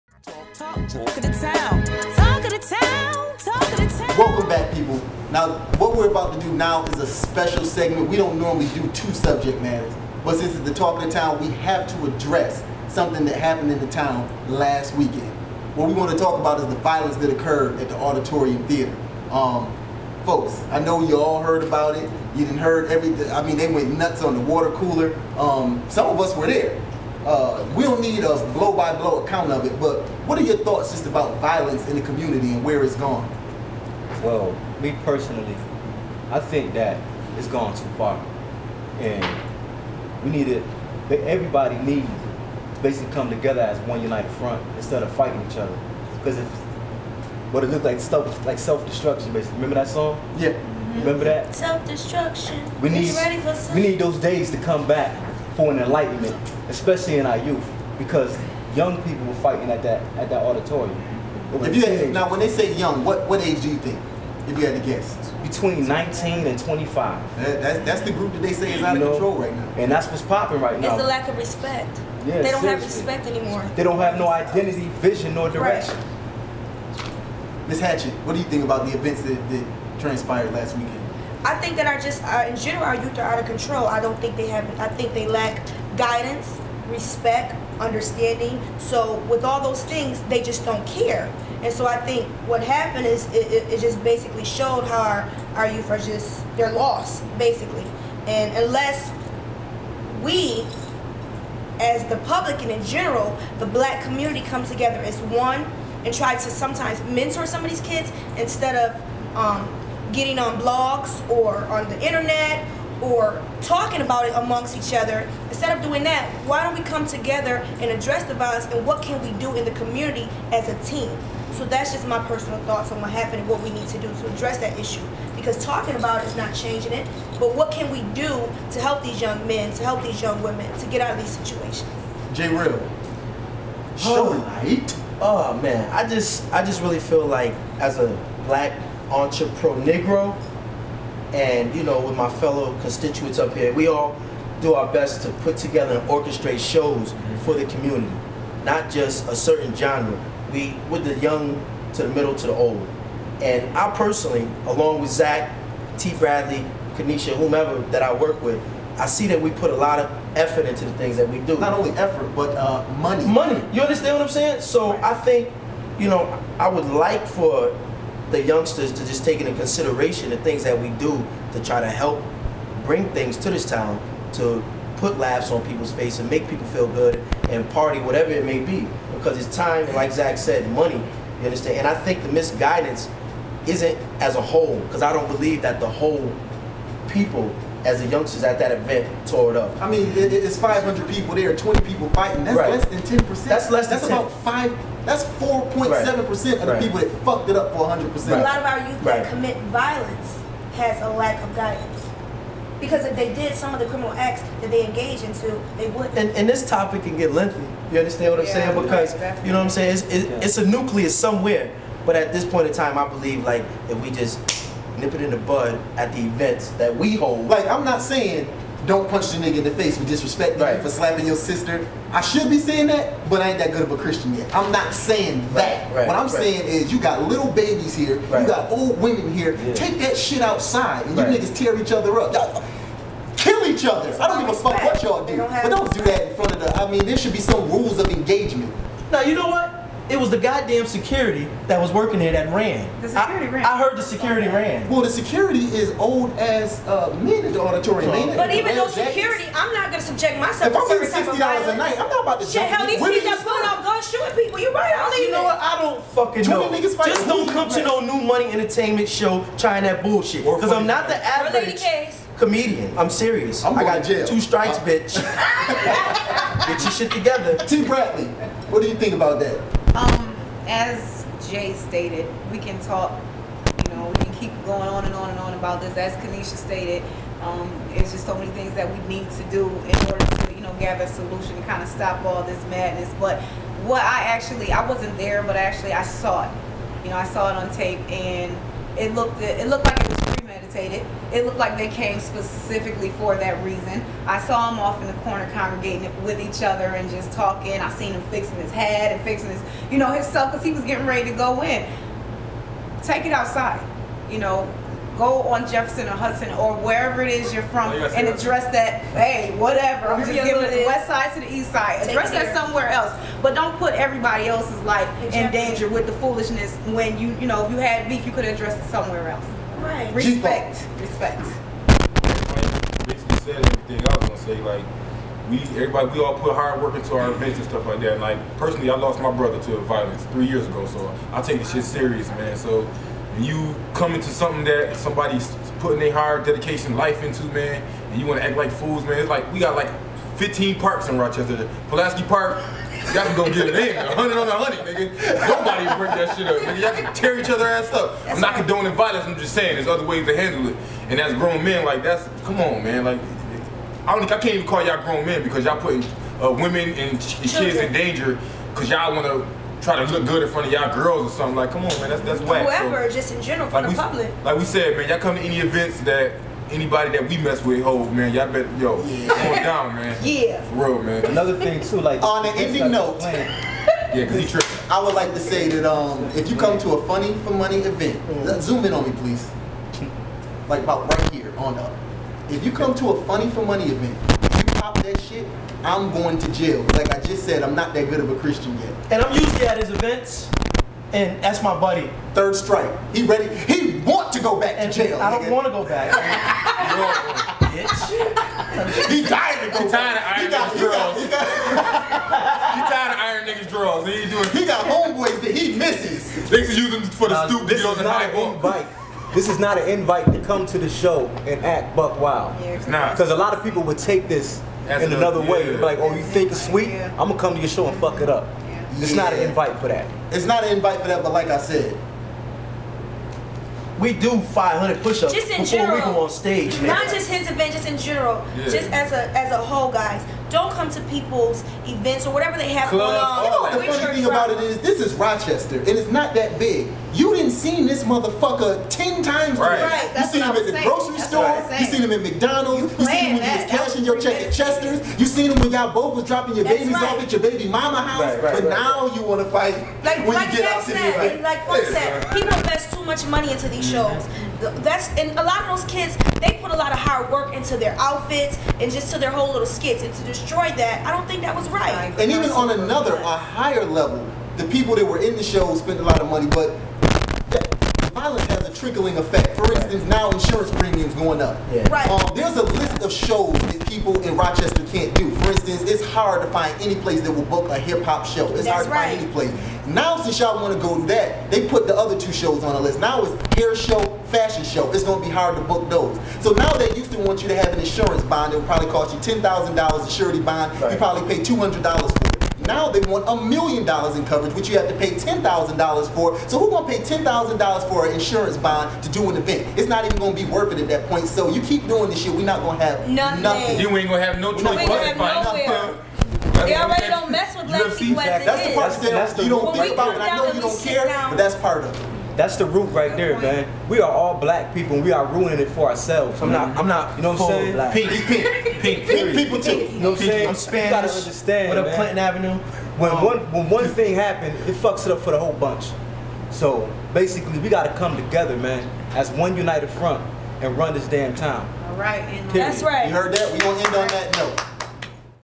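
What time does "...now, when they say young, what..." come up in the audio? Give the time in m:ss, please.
1:02.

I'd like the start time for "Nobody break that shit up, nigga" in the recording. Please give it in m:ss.
5:45.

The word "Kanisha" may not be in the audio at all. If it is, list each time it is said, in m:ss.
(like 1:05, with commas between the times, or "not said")
2:36, 4:36.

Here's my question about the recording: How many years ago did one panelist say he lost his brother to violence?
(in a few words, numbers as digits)
3.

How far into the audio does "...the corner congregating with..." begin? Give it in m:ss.
4:55.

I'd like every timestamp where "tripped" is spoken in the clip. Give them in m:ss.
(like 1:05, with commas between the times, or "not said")
6:14.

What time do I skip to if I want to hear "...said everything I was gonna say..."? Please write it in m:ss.
5:23.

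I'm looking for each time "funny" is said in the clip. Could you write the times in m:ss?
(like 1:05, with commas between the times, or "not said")
6:17, 6:23, 7:14.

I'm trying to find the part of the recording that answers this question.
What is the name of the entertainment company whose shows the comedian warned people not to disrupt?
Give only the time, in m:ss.
4:18.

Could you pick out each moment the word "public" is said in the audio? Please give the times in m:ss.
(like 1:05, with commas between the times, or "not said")
1:42, 6:03.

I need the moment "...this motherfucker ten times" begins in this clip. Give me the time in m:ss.
7:17.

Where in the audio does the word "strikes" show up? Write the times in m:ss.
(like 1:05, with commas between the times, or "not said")
4:24, 6:32.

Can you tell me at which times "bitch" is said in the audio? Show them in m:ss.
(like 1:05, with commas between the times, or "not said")
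4:24, 6:37.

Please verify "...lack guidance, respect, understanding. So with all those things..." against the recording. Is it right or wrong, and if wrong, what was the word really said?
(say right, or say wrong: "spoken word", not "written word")
right.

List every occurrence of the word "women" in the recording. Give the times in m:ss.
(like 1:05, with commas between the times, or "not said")
2:10, 3:49, 5:56.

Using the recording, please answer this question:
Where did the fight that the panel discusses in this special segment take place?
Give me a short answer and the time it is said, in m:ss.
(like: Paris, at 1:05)
Auditorium Theater, at 0:17.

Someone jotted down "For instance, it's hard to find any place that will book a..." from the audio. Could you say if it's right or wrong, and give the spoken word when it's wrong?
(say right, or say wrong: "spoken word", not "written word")
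right.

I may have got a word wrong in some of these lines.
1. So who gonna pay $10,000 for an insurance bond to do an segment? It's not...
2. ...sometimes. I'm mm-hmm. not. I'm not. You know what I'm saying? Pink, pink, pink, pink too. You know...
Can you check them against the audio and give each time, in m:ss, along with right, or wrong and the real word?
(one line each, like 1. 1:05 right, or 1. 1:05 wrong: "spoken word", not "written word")
1. 8:16 wrong: "event", not "segment"
2. 8:35 wrong: "ourselves", not "sometimes".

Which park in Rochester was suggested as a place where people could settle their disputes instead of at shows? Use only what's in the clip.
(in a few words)
Pulaski Park.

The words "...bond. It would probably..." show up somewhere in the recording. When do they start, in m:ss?
8:08.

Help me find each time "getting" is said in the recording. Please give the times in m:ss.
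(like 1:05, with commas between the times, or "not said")
1:50, 5:00.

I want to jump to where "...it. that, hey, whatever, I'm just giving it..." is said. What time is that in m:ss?
5:08.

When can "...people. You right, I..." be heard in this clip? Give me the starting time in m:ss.
4:14.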